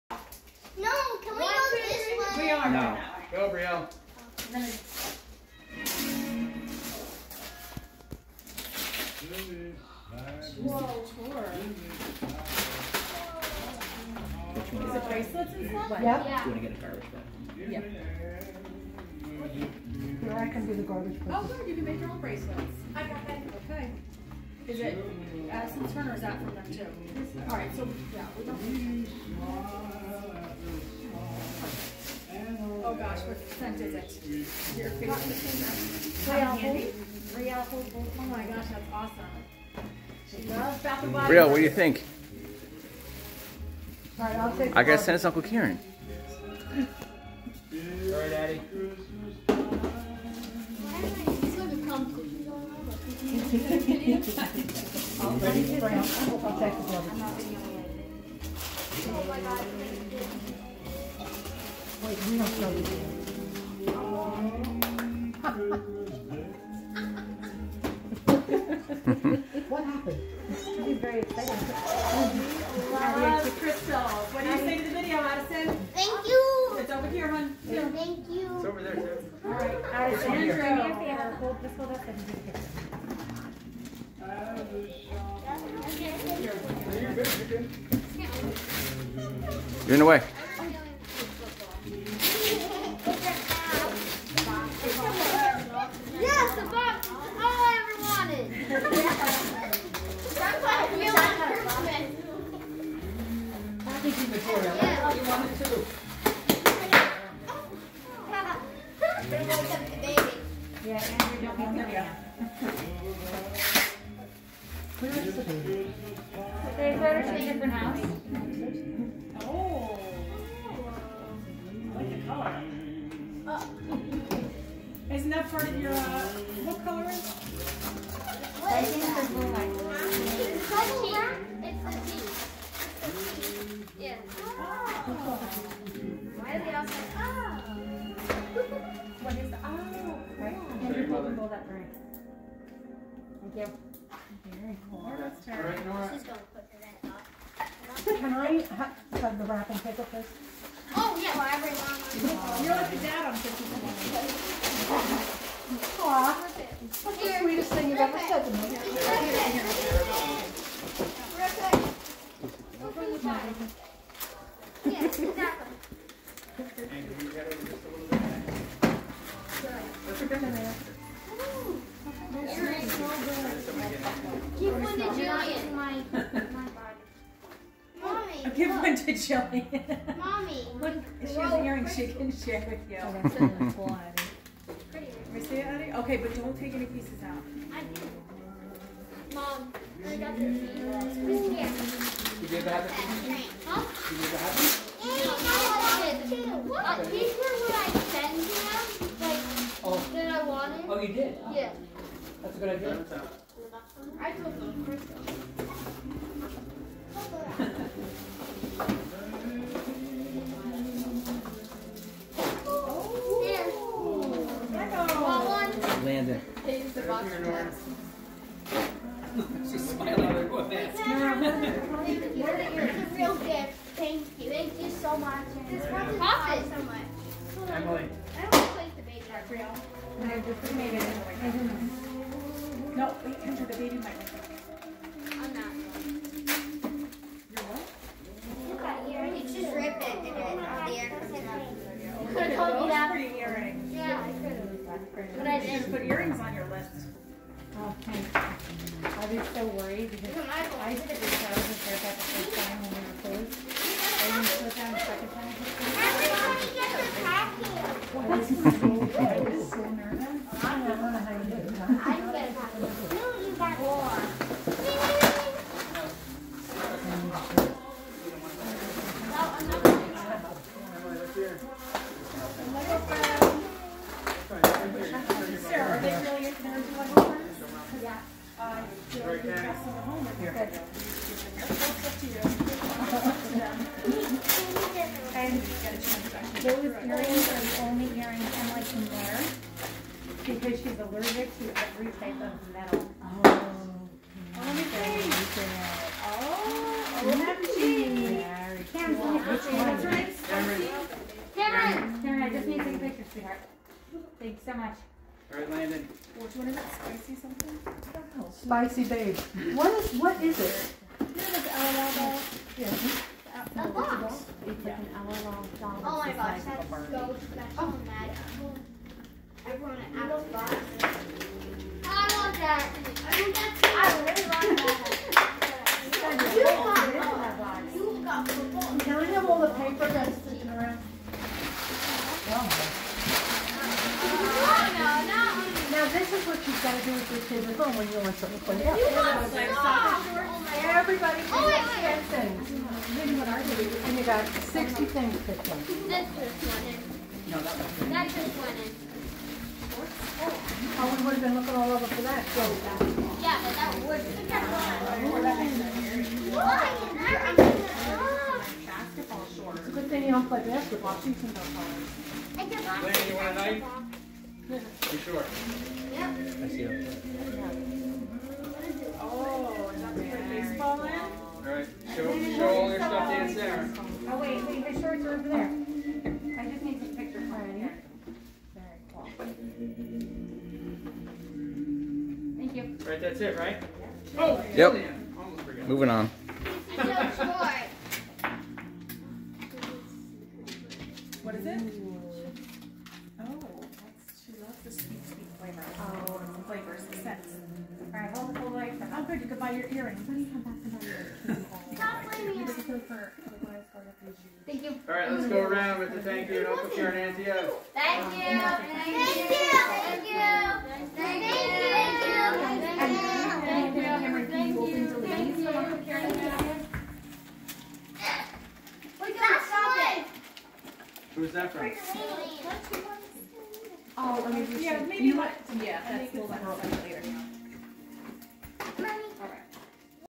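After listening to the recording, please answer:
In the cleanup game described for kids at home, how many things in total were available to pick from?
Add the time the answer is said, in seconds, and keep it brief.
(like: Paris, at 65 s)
60, at 344 s.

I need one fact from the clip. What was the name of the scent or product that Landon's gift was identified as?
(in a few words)
Spicy babe.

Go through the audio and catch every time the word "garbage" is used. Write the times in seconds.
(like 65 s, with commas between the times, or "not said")
16 s, 20 s.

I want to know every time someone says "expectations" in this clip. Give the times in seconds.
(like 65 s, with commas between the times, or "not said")
not said.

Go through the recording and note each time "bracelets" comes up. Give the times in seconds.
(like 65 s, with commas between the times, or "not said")
15 s, 22 s.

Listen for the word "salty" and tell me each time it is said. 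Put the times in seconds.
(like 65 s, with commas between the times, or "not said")
not said.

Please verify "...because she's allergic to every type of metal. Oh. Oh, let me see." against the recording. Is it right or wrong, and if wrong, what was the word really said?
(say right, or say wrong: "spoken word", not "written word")
right.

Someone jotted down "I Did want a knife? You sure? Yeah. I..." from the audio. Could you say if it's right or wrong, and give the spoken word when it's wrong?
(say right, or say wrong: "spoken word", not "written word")
wrong: "You", not "Did".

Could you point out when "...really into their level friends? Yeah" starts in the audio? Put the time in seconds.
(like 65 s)
276 s.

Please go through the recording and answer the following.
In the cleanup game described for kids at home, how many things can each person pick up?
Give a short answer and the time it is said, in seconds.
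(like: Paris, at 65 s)
10, at 342 s.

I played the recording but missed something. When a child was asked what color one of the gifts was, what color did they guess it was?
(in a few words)
blue.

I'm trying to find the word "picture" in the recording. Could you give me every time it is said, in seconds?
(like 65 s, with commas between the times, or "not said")
302 s, 377 s.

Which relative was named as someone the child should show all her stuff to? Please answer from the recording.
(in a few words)
Aunt.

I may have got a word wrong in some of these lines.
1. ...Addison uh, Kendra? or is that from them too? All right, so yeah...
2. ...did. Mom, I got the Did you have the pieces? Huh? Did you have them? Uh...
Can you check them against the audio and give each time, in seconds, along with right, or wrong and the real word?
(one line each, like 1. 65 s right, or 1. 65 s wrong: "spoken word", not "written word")
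1. 25 s wrong: "Turner", not "Kendra"
2. 187 s right.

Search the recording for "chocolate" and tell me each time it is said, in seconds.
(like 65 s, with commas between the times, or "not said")
not said.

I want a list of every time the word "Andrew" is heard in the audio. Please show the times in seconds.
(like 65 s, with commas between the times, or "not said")
80 s, 110 s.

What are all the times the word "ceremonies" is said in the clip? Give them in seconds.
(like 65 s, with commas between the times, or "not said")
not said.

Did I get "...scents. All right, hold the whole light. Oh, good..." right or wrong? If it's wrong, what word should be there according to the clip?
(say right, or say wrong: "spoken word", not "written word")
right.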